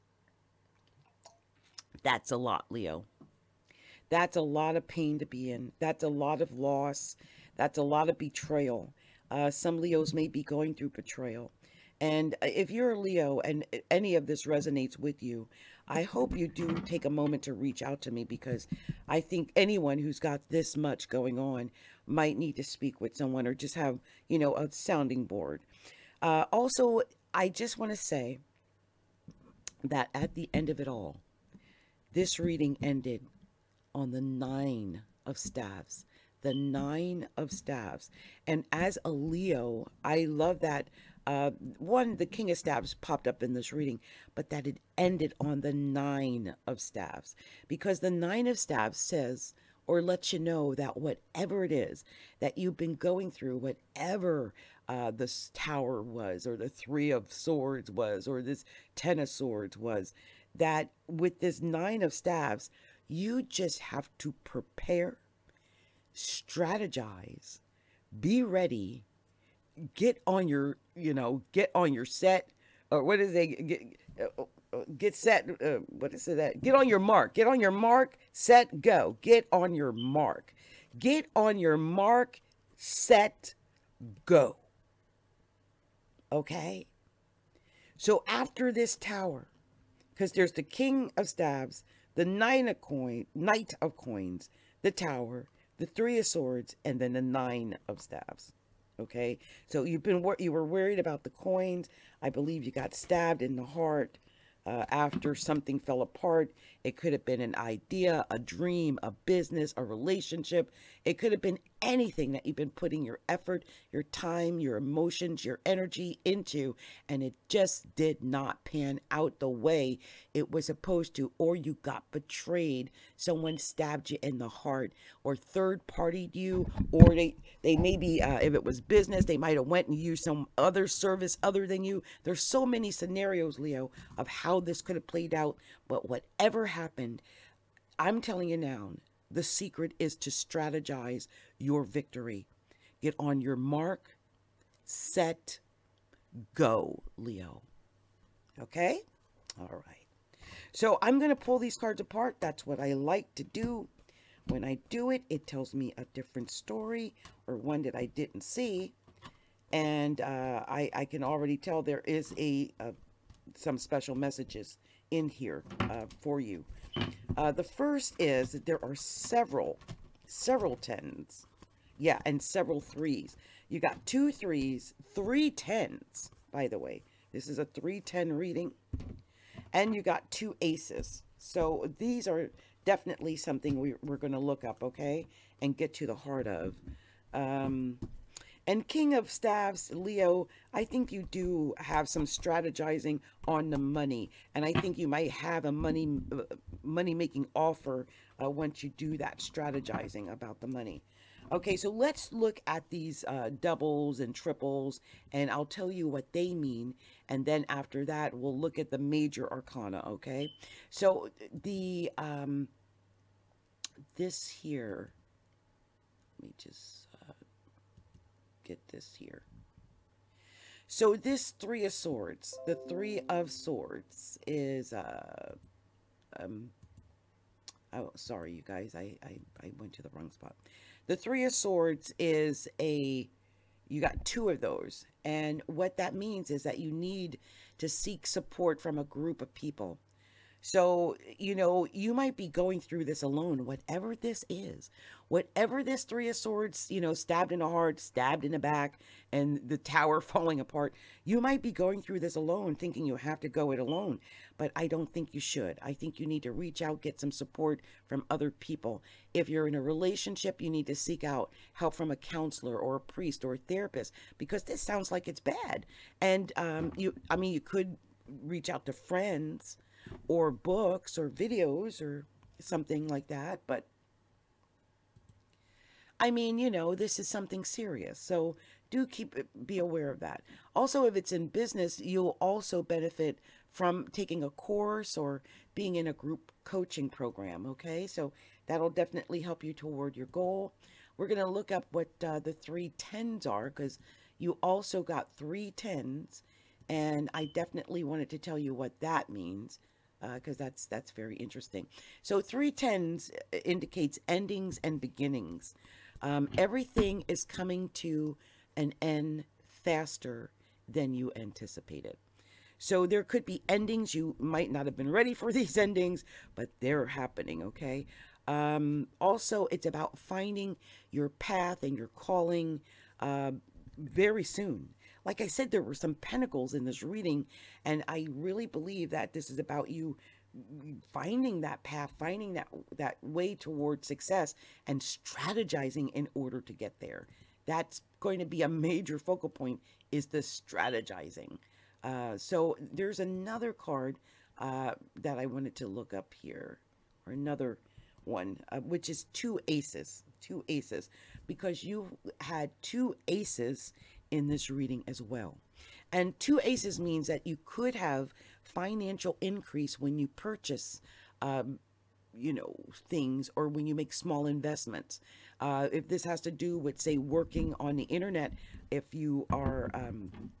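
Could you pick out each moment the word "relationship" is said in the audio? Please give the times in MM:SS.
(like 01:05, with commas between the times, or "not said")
01:49, 04:19.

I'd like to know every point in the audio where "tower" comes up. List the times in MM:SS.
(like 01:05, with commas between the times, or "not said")
00:55, 01:28, 01:34, 04:09.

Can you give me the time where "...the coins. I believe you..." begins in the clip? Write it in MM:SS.
01:41.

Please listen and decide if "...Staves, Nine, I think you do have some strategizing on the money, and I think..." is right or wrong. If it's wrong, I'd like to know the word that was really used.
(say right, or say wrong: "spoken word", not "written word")
wrong: "Leo", not "Nine".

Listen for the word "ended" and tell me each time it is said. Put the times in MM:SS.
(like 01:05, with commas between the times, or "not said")
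00:32, 00:44.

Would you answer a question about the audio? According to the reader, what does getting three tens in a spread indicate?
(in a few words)
endings and beginnings.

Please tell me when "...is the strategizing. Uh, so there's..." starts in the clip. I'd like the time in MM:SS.
05:40.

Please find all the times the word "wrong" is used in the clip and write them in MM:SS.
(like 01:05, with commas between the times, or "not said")
03:50.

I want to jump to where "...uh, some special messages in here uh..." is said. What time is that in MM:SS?
02:42.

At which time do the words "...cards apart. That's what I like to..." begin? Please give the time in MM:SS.
02:31.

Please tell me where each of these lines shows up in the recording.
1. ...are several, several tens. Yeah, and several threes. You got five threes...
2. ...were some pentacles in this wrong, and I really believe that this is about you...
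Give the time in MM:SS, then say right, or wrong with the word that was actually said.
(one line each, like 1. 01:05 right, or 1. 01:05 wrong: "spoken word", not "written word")
1. 02:48 wrong: "two", not "five"
2. 05:25 wrong: "reading", not "wrong".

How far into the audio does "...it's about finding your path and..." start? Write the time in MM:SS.
05:19.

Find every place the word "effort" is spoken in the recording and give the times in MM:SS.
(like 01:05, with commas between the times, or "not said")
01:53.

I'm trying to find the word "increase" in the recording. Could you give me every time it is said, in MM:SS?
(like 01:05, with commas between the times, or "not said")
05:59.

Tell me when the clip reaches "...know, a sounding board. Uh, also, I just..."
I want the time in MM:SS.
00:24.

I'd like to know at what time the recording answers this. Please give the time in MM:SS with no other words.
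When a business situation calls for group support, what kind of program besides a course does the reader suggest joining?
04:46.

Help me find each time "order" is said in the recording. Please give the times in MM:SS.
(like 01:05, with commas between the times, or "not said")
05:36.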